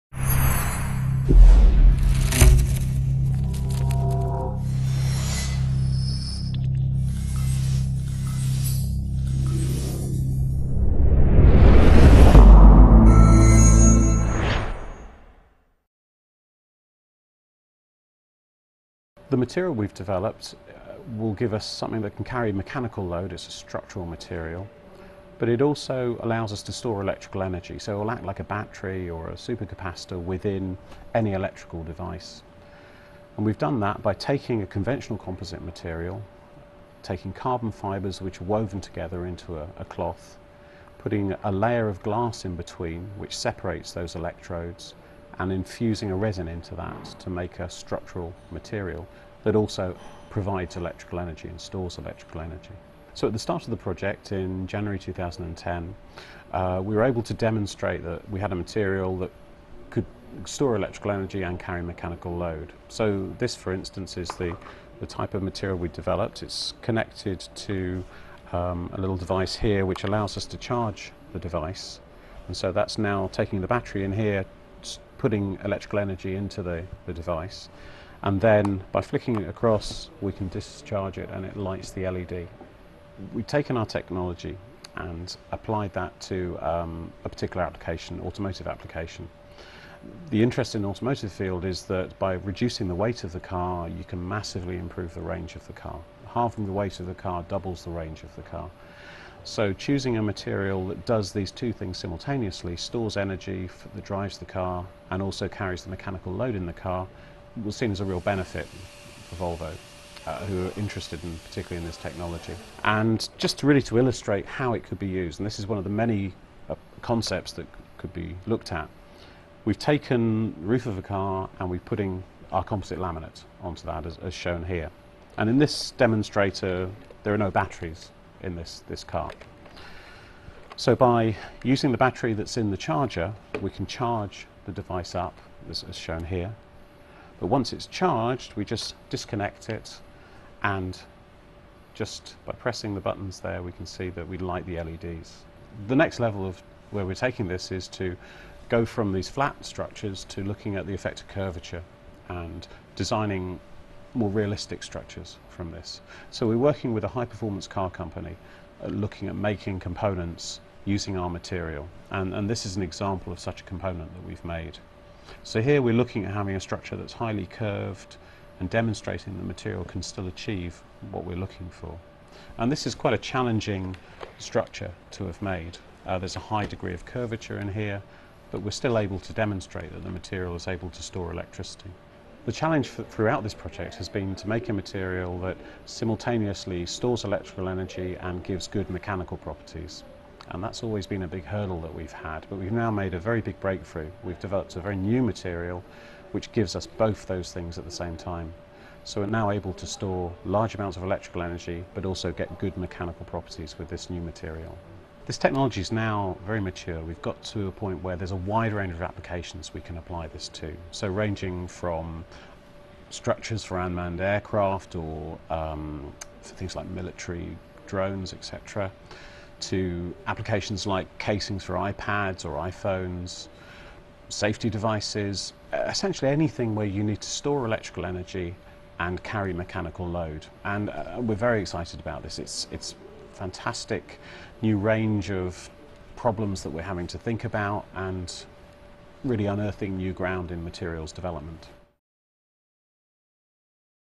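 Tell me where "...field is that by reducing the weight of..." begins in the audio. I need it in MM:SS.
01:31.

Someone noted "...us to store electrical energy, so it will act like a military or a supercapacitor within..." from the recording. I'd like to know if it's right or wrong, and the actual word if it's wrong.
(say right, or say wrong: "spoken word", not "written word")
wrong: "battery", not "military".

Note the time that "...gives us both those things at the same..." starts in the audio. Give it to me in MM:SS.
03:16.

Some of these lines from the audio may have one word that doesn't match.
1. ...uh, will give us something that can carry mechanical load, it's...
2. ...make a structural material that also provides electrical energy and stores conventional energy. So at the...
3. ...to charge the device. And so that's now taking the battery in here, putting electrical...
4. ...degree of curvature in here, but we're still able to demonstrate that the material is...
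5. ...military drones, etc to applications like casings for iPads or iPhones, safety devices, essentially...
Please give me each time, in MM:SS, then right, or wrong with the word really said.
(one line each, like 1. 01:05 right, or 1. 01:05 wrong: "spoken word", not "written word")
1. 00:20 right
2. 00:47 wrong: "electrical", not "conventional"
3. 01:10 right
4. 02:56 right
5. 03:36 right.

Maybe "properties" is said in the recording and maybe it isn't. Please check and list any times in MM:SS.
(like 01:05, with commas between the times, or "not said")
03:09, 03:23.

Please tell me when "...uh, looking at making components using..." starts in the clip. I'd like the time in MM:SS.
02:38.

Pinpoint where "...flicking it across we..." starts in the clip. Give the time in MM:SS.
01:19.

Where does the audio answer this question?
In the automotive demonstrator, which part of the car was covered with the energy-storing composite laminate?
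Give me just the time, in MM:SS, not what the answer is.
02:00.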